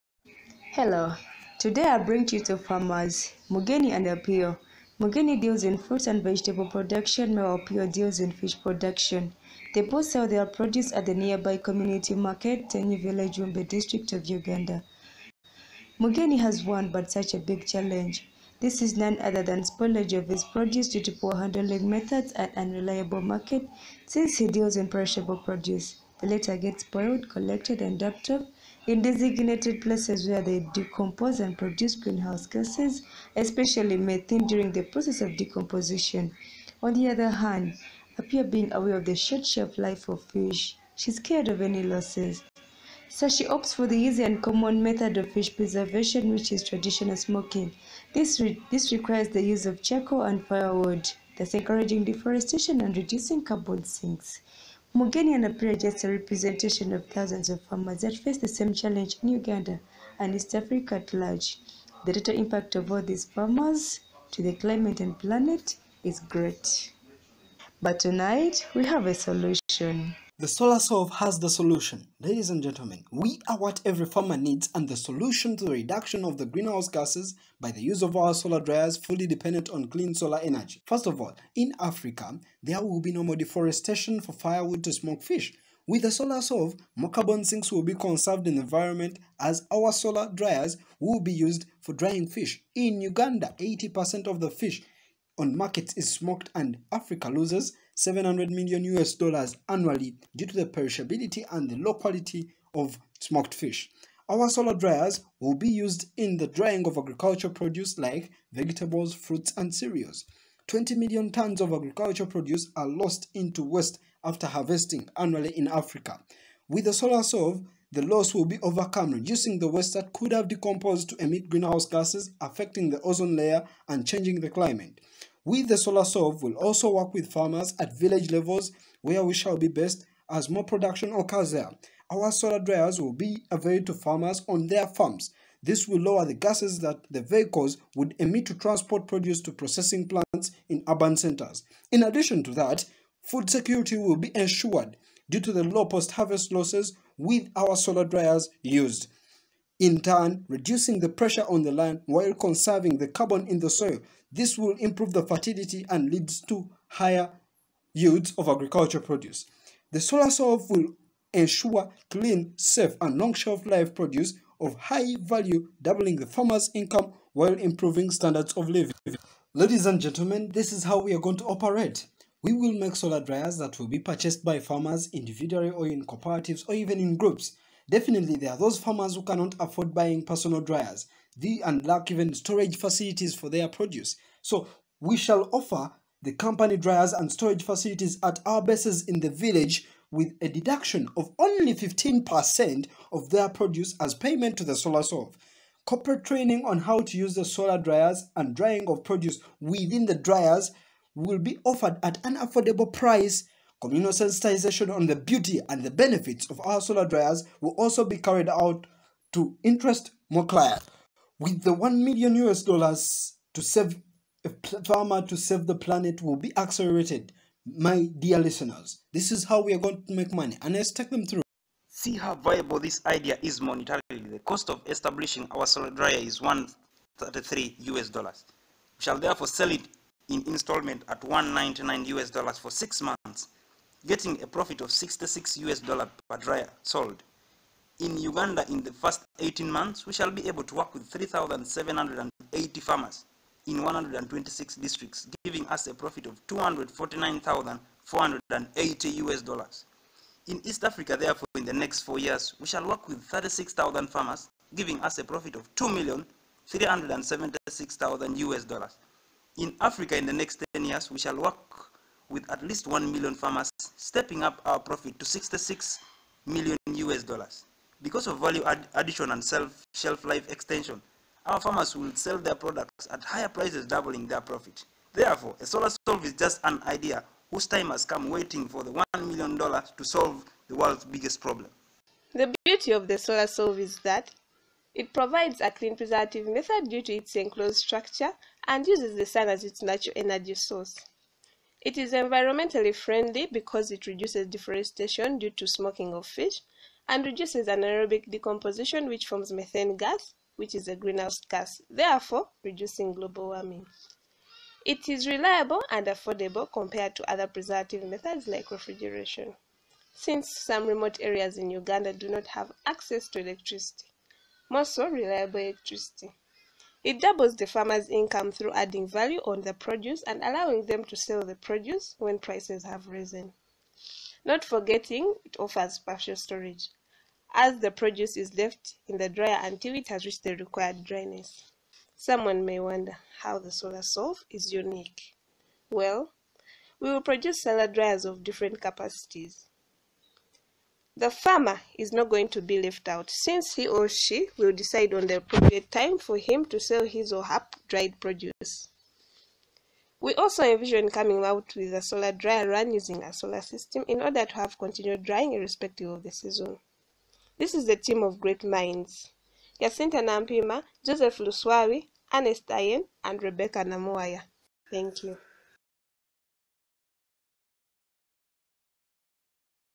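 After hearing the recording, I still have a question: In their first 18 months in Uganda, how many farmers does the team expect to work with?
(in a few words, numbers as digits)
3,780.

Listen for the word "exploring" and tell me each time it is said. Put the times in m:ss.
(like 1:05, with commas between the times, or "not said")
not said.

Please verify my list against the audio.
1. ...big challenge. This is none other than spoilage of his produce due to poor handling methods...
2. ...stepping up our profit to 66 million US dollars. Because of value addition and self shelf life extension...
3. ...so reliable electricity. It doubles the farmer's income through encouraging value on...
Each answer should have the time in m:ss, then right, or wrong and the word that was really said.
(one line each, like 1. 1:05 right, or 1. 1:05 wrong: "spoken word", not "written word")
1. 0:17 right
2. 4:24 right
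3. 5:14 wrong: "adding", not "encouraging".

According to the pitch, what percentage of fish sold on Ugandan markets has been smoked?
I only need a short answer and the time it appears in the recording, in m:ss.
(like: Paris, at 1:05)
80%, at 1:33.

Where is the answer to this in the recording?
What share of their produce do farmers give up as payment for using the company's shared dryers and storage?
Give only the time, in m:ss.
3:11.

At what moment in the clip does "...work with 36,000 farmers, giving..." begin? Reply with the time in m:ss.
4:12.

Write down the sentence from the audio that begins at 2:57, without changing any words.
Definitely, there are those farmers who cannot afford buying personal dryers the, and lack even storage facilities for their produce.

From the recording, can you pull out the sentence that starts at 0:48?
This, re this requires the use of charcoal and firewood, thus encouraging deforestation and reducing carbon sinks.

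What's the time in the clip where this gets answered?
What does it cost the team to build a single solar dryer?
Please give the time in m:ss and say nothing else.
3:46.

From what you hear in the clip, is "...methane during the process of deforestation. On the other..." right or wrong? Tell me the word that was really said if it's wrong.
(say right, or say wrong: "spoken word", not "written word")
wrong: "decomposition", not "deforestation".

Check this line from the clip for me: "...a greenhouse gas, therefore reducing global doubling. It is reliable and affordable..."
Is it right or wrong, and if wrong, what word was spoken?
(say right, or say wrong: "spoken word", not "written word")
wrong: "warming", not "doubling".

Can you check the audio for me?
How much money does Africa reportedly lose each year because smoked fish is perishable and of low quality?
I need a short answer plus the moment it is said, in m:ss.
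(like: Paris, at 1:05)
700 million US dollars, at 1:38.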